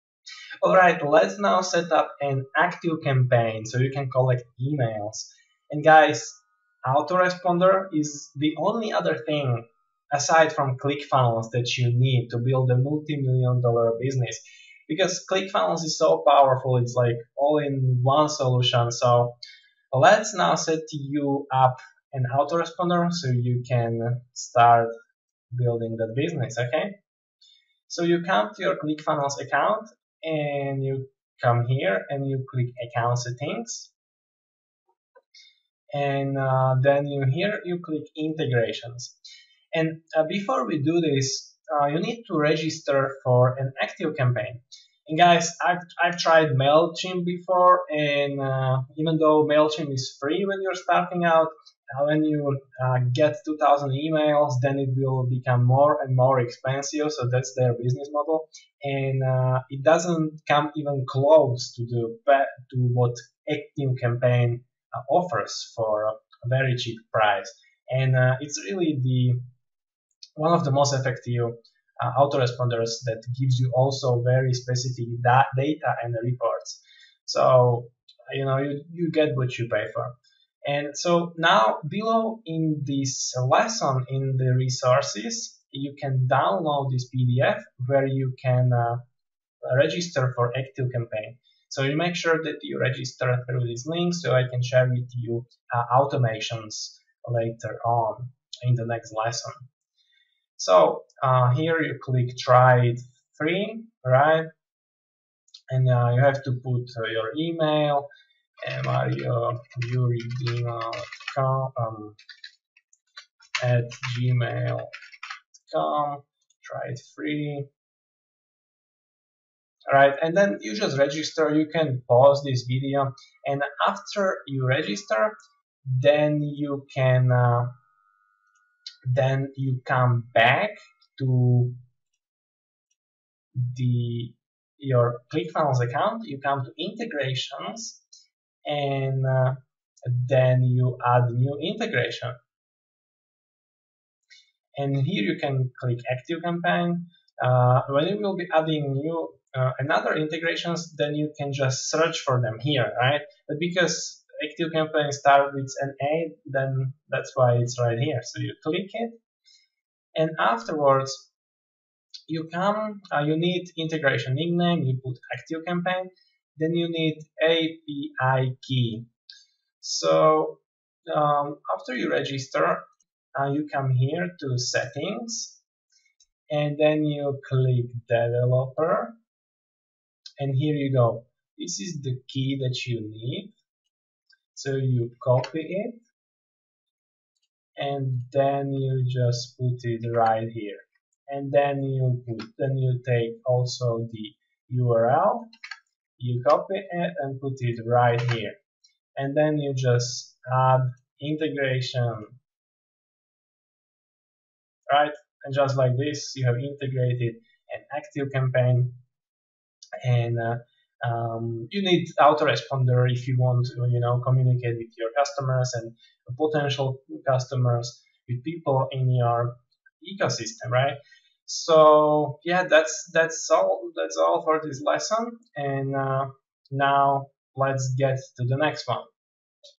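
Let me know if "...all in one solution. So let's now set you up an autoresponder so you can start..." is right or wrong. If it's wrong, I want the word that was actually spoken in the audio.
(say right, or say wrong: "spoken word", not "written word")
right.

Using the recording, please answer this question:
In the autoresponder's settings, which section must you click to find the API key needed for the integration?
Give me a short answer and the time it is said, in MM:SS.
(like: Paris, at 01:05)
developer, at 02:58.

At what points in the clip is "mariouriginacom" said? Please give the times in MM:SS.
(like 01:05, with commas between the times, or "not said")
01:48.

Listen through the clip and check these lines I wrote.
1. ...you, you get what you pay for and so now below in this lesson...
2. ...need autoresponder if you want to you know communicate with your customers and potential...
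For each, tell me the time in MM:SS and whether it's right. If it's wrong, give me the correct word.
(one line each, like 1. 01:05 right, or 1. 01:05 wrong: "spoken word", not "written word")
1. 01:18 right
2. 03:31 right.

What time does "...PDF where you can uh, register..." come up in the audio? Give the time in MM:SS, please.
01:27.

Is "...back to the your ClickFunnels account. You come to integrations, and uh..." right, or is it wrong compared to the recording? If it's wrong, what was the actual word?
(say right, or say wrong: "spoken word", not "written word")
right.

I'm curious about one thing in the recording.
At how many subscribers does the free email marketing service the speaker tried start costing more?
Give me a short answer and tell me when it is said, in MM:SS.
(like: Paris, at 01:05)
2000, at 00:53.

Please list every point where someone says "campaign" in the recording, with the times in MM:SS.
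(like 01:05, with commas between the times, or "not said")
00:03, 00:44, 01:04, 01:30, 02:26, 02:34, 02:45, 03:28.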